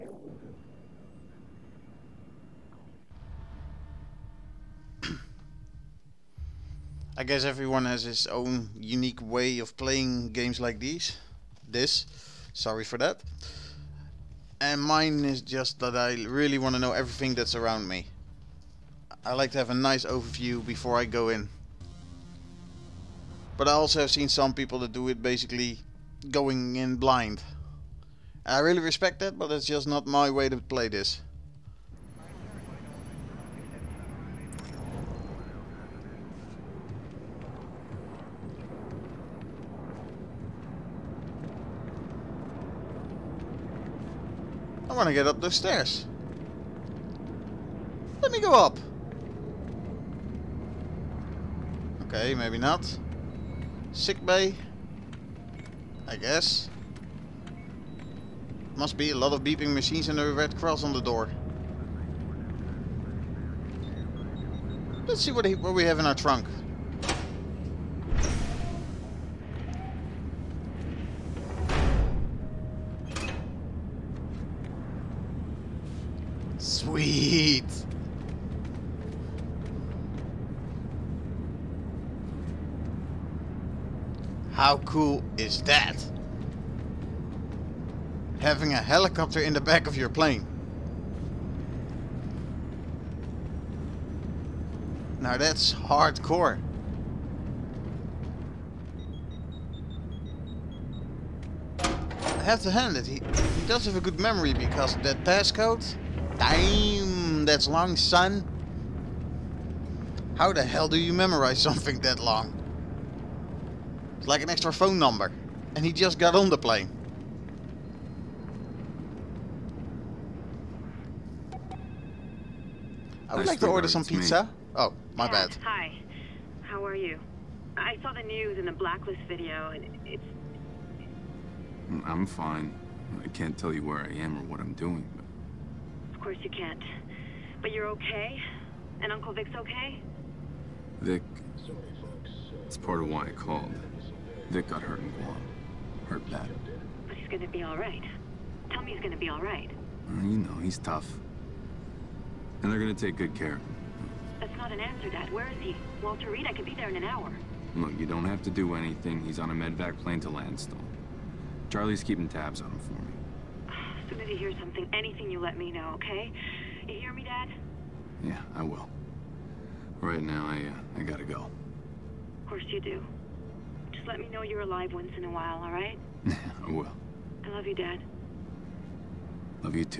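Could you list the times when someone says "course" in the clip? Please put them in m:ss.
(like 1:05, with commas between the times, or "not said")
2:16, 2:52.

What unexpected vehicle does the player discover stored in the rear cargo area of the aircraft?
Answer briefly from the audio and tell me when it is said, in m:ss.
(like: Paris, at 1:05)
helicopter, at 1:28.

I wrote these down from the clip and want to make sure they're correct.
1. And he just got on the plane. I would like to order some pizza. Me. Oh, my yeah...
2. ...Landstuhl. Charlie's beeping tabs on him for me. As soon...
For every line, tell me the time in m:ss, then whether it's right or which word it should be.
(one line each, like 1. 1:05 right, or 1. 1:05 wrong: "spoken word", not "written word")
1. 1:55 right
2. 2:40 wrong: "keeping", not "beeping".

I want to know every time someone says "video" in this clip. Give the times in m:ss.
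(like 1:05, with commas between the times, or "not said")
2:09.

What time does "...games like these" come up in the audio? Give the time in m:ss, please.
0:10.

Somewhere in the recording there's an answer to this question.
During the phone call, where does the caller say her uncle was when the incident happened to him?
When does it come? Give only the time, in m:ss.
2:25.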